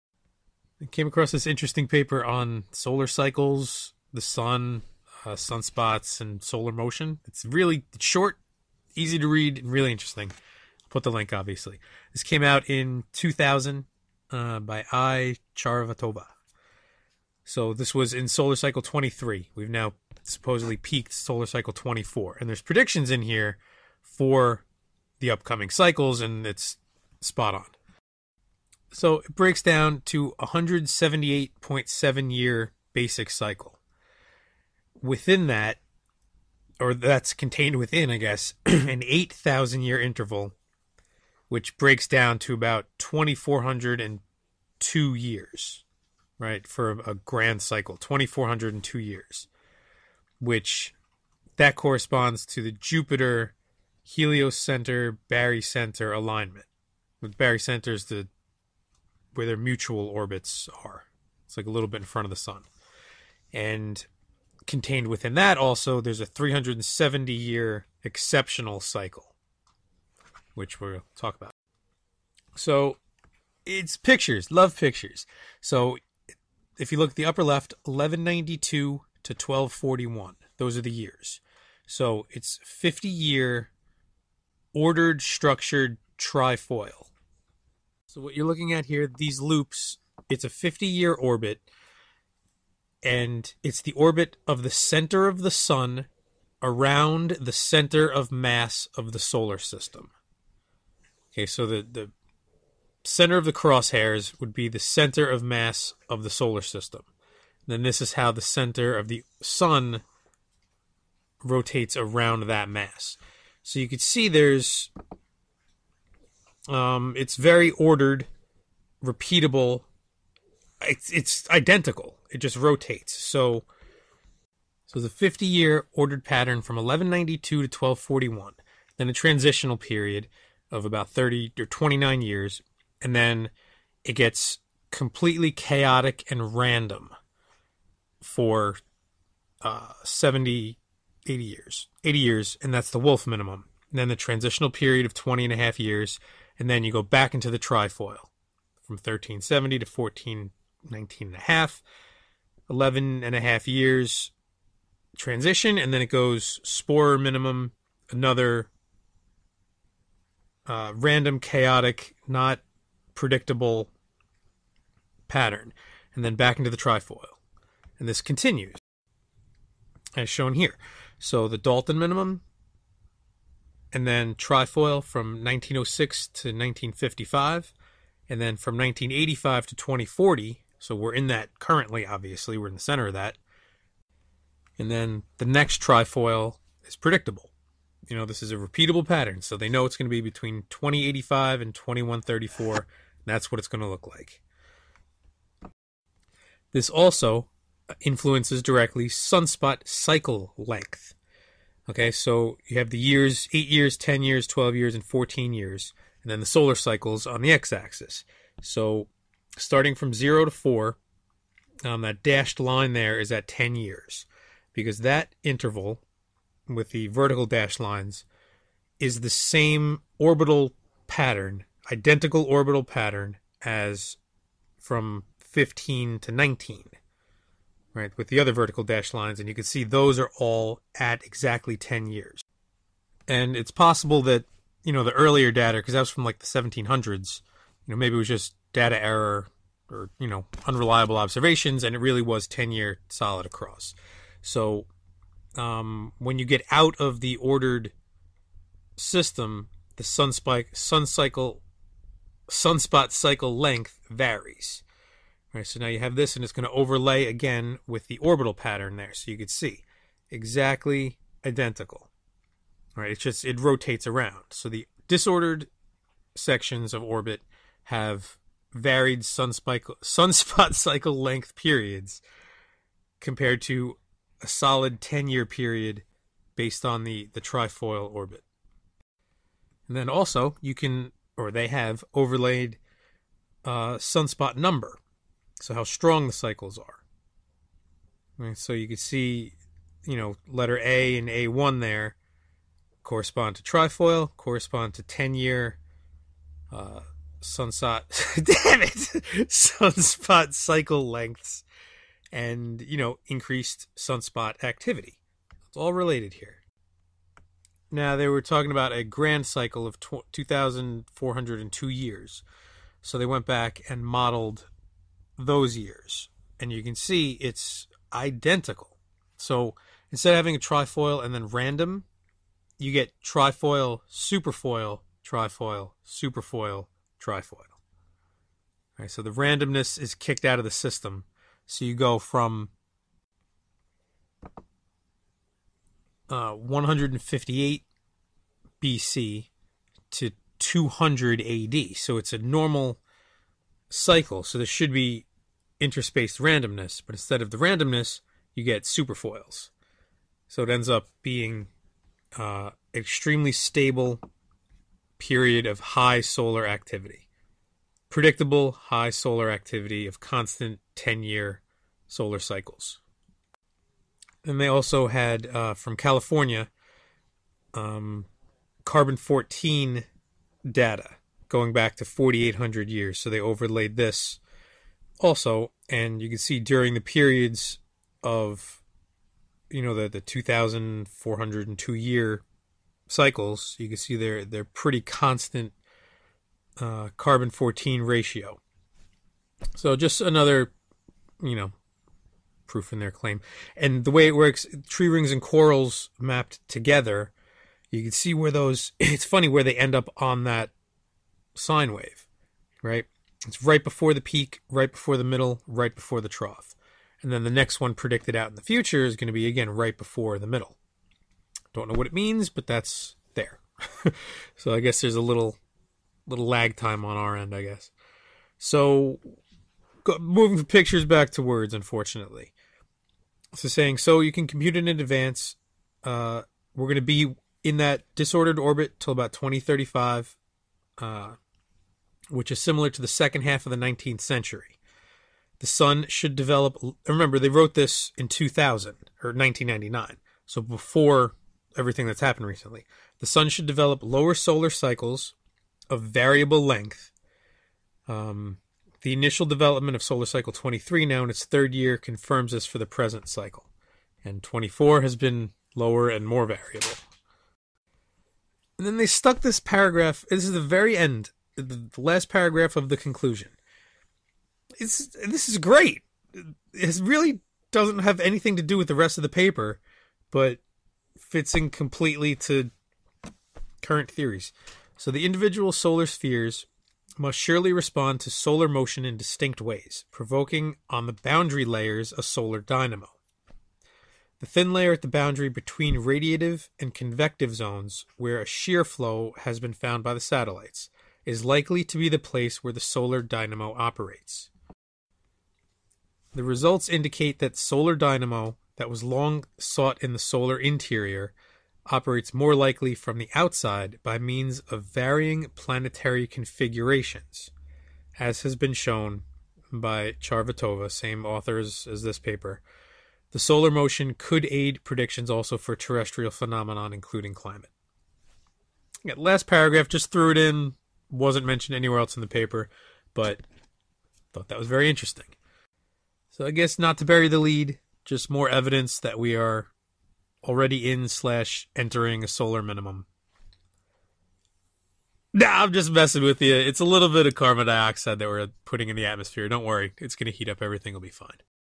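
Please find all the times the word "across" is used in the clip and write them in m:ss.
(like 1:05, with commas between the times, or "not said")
0:01, 4:03.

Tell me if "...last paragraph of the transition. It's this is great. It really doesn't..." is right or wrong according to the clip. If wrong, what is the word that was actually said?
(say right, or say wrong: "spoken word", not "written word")
wrong: "conclusion", not "transition".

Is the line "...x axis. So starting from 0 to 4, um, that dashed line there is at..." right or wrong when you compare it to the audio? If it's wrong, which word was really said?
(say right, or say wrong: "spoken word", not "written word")
right.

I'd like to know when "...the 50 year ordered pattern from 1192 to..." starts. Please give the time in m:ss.
2:04.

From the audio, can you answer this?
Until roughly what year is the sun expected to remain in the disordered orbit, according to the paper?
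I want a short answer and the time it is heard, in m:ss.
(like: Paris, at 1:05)
2035, at 7:09.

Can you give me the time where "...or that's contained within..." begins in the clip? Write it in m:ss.
0:36.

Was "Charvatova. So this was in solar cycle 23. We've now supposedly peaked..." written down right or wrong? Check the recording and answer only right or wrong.
right.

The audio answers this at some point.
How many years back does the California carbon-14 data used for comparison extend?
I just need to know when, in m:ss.
6:12.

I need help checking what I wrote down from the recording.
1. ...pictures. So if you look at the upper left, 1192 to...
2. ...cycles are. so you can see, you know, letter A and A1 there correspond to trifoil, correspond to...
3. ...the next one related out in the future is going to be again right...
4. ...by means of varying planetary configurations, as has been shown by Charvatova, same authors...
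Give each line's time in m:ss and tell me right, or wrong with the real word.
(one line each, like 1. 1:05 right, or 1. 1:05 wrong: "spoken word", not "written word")
1. 1:14 right
2. 4:46 right
3. 6:47 wrong: "predicted", not "related"
4. 8:24 right.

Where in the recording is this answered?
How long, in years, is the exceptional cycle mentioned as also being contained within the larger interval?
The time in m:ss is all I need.
1:06.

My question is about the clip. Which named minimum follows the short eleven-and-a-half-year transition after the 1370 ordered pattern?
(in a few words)
Spörer minimum.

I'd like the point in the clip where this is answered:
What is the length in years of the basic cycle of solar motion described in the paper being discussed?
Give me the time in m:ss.
0:30.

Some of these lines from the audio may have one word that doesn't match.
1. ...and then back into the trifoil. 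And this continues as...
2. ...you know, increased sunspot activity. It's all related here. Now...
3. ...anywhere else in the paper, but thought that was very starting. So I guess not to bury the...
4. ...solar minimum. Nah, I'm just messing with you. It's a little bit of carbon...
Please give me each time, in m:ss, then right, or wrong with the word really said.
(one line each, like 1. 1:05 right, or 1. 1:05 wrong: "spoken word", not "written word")
1. 2:46 right
2. 5:02 right
3. 8:41 wrong: "interesting", not "starting"
4. 8:52 right.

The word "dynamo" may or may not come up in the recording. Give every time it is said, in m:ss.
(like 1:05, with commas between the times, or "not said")
8:02, 8:13, 8:17.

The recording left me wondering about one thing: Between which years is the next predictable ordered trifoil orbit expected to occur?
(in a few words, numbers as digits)
2085 to 2134.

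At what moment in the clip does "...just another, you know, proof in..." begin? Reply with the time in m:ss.
6:29.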